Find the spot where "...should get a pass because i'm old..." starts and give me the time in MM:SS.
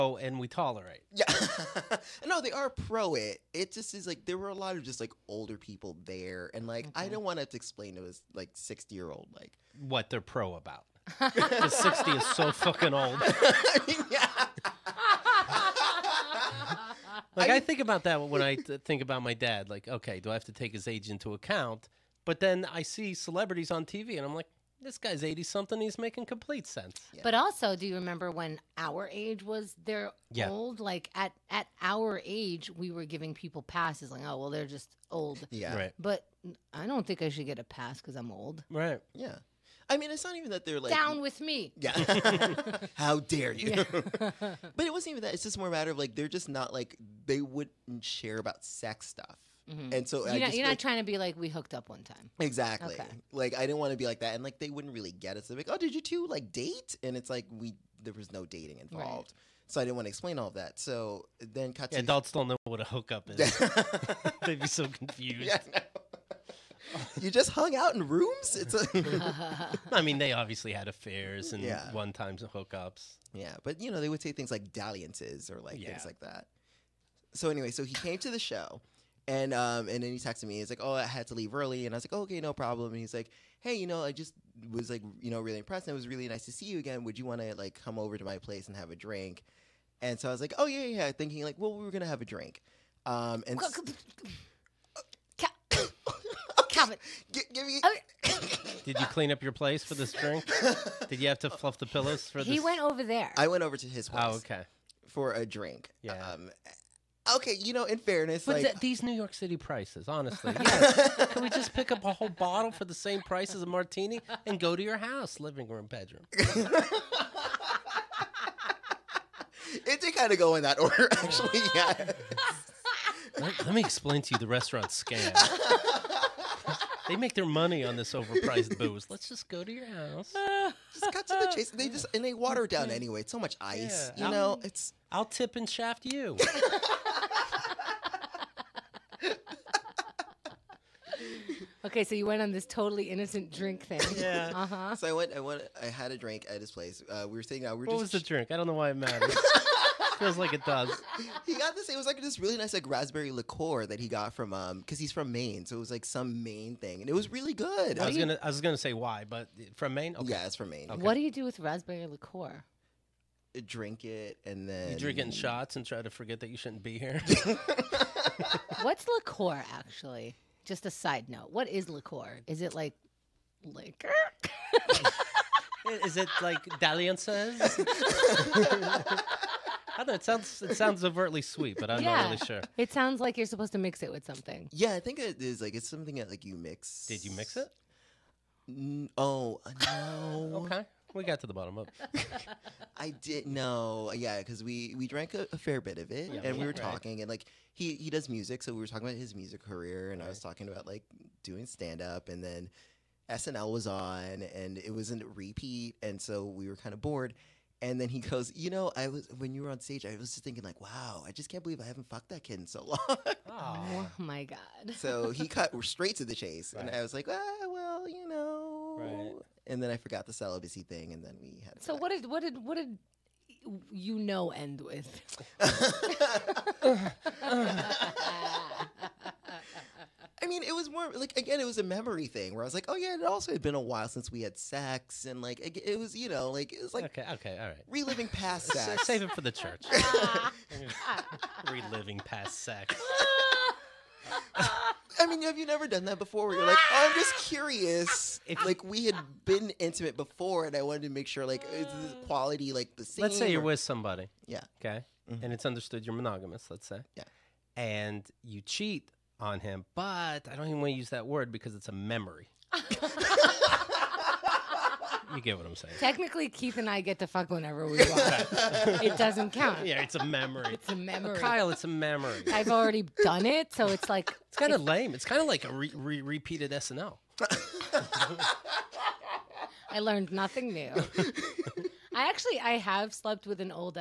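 00:37.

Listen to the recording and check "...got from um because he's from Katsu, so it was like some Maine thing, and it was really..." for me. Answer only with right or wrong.
wrong.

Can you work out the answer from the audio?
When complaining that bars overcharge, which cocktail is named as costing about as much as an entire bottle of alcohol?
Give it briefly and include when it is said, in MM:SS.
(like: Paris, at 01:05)
martini, at 01:53.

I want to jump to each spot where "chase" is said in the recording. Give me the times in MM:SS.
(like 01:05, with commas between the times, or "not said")
02:11, 03:36.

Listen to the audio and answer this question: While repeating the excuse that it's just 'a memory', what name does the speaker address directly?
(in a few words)
Kyle.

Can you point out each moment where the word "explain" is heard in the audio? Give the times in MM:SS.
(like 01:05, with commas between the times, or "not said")
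00:07, 01:00, 02:03.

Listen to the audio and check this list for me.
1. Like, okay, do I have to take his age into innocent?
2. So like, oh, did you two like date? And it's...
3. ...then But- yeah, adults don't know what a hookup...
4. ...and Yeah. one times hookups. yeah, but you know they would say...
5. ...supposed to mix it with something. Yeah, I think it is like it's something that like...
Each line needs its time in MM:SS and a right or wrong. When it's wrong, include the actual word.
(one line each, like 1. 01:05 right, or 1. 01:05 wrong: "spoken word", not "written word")
1. 00:19 wrong: "account", not "innocent"
2. 00:55 right
3. 01:01 wrong: "Katsu", not "But"
4. 01:11 right
5. 03:03 right.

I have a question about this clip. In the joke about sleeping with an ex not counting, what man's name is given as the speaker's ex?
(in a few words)
Keith.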